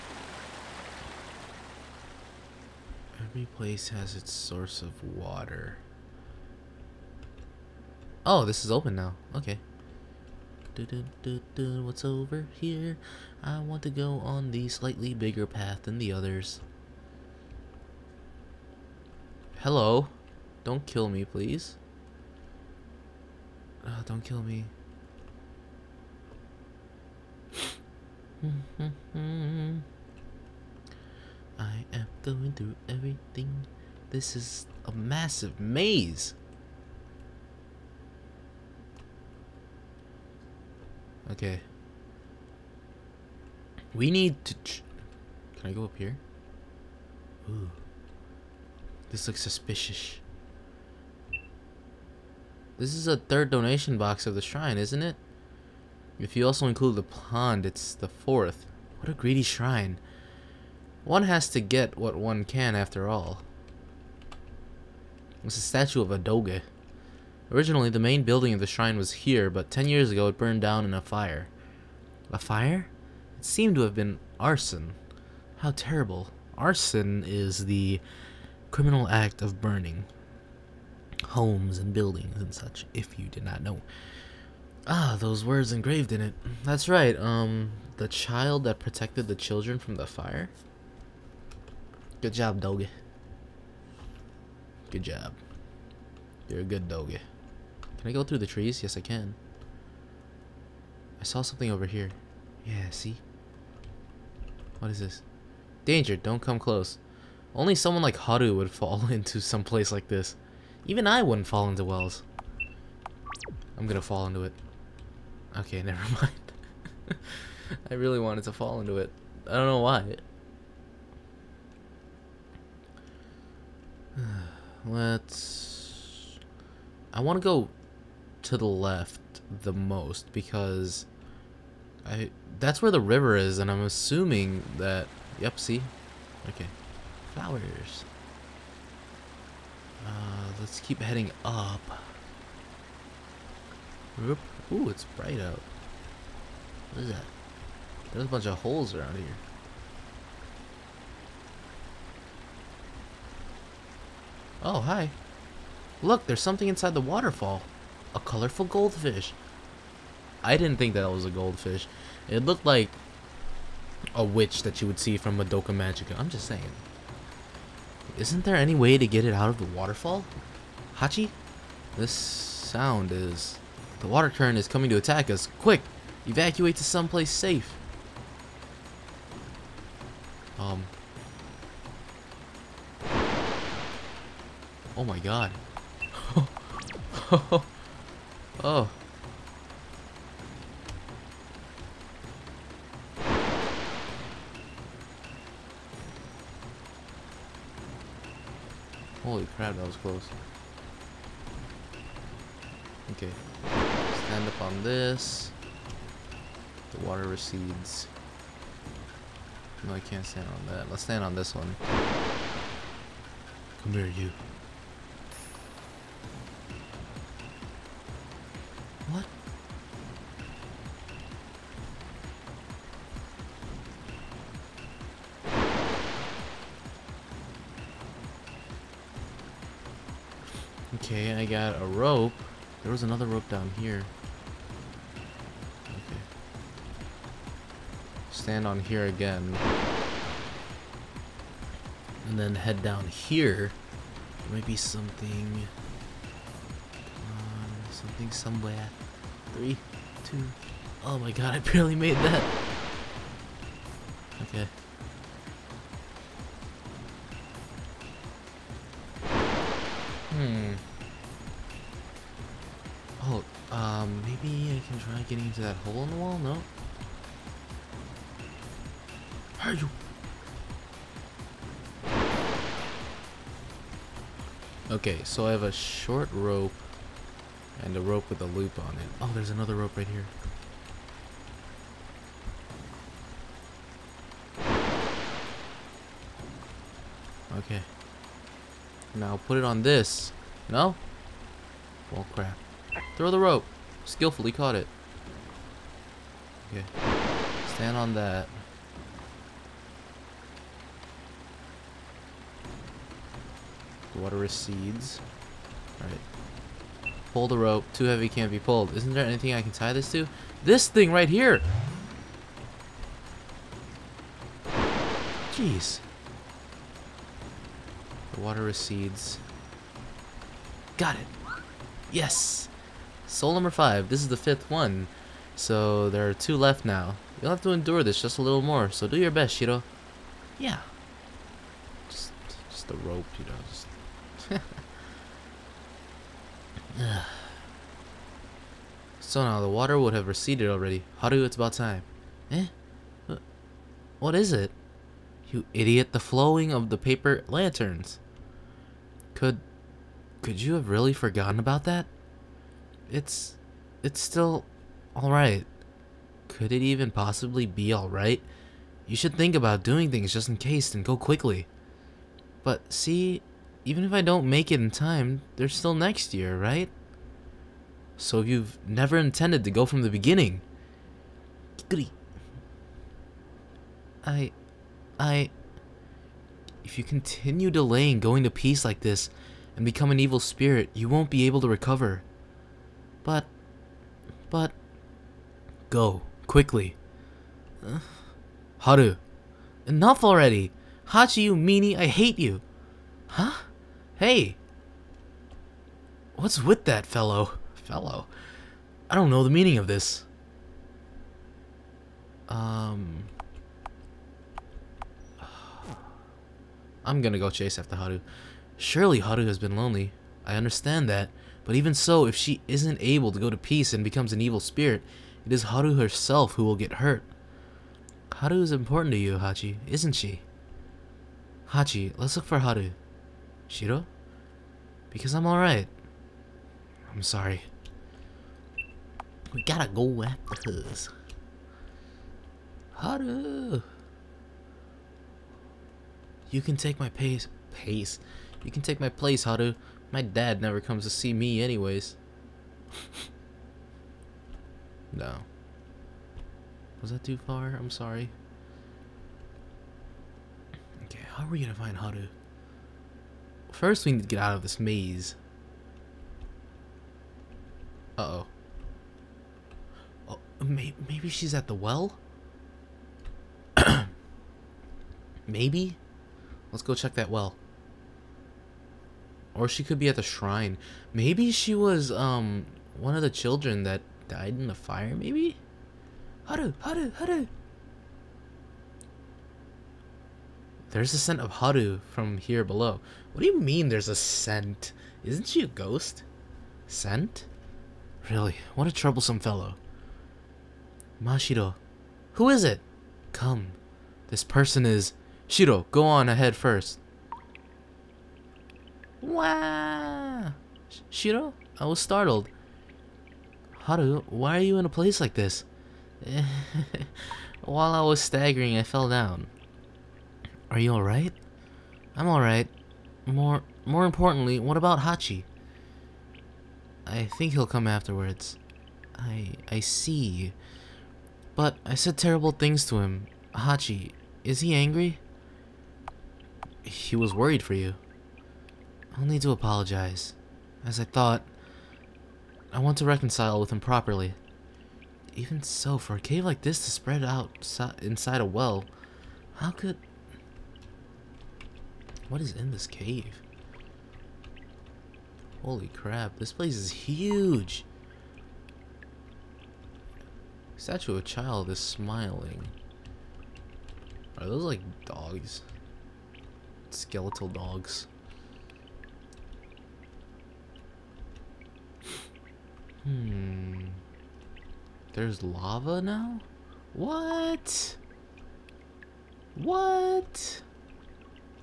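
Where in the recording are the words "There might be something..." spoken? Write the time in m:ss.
4:04.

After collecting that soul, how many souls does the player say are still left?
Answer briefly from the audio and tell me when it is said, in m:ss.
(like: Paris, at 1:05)
2, at 5:26.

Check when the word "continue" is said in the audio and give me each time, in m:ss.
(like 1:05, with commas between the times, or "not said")
6:17.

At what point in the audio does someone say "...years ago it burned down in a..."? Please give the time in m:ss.
1:09.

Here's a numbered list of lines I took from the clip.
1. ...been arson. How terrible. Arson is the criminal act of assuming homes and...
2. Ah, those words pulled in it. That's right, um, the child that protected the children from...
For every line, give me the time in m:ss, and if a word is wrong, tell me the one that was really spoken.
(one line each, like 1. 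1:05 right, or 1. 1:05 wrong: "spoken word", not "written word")
1. 1:13 wrong: "burning", not "assuming"
2. 1:24 wrong: "engraved", not "pulled".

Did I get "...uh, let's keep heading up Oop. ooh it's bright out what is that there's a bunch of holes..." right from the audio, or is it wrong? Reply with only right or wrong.
right.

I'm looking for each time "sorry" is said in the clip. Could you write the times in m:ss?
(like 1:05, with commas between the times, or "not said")
7:07, 7:27.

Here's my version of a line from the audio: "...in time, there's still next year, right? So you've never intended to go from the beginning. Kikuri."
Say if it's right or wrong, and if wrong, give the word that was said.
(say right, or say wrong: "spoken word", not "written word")
right.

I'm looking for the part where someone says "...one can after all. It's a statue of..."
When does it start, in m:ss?
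1:02.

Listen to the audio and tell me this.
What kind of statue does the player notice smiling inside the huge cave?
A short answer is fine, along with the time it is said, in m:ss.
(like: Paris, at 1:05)
Statue of a child, at 9:10.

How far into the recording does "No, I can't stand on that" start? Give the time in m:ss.
3:29.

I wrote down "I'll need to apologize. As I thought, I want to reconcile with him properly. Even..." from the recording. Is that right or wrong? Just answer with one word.
right.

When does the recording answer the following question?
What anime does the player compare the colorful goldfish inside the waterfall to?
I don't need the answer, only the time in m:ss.
2:45.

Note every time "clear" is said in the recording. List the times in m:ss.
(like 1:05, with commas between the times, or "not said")
not said.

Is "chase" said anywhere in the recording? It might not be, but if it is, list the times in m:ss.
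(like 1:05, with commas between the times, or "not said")
6:47.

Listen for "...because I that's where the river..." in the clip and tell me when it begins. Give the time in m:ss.
2:10.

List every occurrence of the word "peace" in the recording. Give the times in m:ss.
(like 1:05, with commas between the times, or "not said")
6:18, 6:53.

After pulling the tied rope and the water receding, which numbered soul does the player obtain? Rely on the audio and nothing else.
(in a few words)
5.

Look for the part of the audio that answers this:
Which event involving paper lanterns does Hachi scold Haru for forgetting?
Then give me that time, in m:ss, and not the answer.
5:46.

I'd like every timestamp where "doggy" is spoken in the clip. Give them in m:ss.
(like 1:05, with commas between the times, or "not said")
1:32, 1:36.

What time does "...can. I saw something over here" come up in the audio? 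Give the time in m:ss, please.
1:39.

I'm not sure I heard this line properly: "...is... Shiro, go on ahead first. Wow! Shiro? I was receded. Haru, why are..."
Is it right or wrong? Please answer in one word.
wrong.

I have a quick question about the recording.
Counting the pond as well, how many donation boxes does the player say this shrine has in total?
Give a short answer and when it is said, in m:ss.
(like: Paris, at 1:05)
4, at 0:58.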